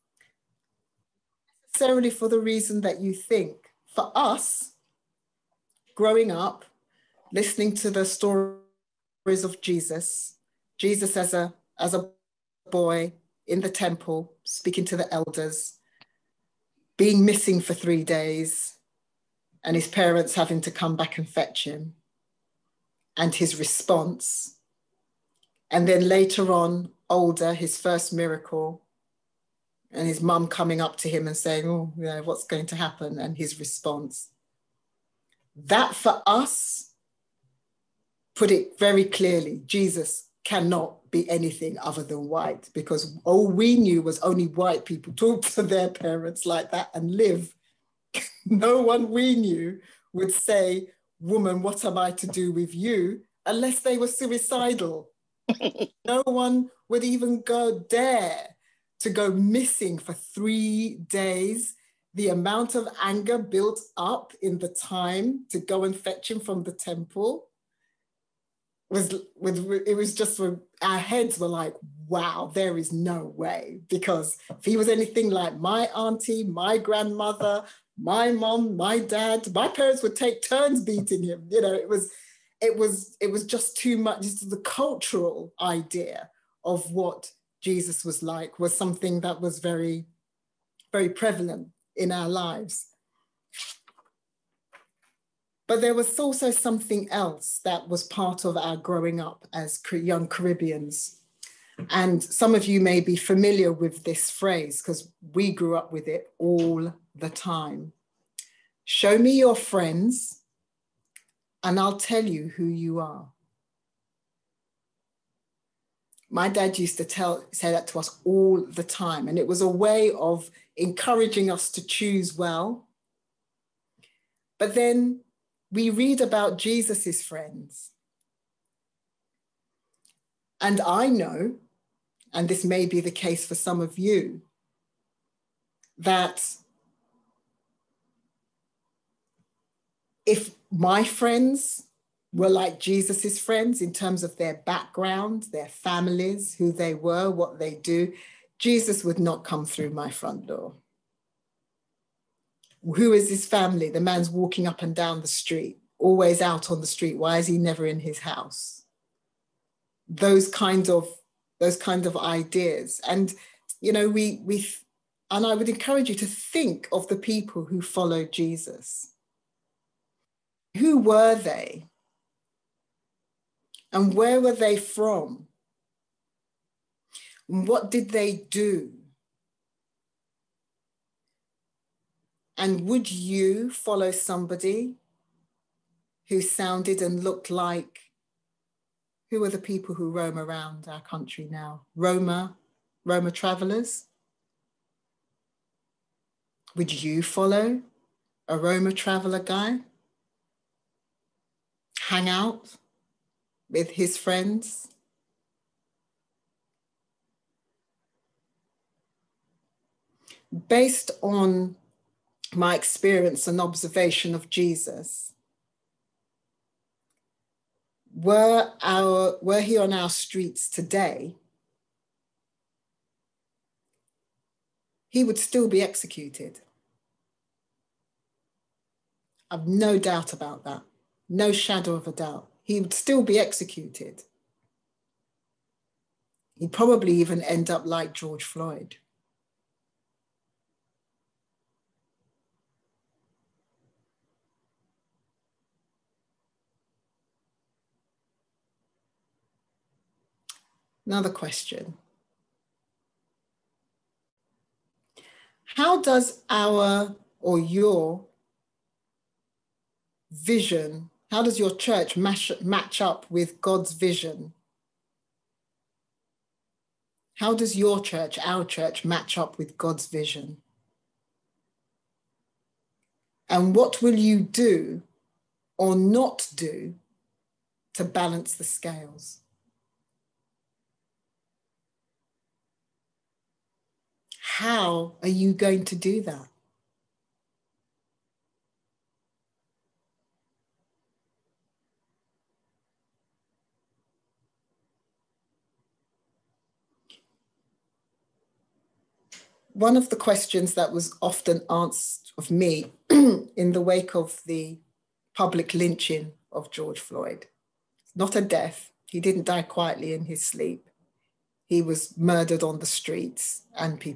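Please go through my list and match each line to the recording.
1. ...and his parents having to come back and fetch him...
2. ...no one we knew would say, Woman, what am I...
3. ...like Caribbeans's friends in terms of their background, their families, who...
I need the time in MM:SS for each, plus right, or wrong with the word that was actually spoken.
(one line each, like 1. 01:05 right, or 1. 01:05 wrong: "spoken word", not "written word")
1. 00:19 right
2. 00:48 right
3. 02:22 wrong: "Jesus", not "Caribbeans".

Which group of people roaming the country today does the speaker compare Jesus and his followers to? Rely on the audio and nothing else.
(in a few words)
Roma travelers.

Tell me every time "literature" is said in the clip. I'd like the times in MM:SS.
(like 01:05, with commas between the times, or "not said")
not said.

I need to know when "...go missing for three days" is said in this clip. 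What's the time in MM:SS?
00:59.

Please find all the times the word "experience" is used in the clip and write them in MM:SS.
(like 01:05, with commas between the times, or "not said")
03:32.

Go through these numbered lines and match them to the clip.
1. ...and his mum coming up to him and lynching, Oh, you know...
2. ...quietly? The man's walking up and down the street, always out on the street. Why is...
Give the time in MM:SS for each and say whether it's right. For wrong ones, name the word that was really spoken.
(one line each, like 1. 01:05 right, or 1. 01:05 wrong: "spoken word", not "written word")
1. 00:29 wrong: "saying", not "lynching"
2. 02:33 wrong: "family", not "quietly".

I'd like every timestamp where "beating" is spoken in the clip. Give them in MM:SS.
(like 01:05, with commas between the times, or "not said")
01:20.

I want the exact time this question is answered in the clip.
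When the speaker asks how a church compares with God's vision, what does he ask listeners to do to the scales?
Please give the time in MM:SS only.
04:38.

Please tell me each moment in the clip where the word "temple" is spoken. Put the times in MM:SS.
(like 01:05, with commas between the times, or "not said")
00:13, 01:06.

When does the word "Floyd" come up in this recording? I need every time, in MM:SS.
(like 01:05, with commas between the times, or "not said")
03:58, 05:06.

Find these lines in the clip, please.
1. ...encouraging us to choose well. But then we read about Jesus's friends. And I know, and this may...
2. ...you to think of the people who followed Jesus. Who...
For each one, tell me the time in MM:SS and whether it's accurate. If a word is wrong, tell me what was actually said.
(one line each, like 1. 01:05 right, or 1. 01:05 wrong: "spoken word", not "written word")
1. 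02:00 right
2. 02:46 right.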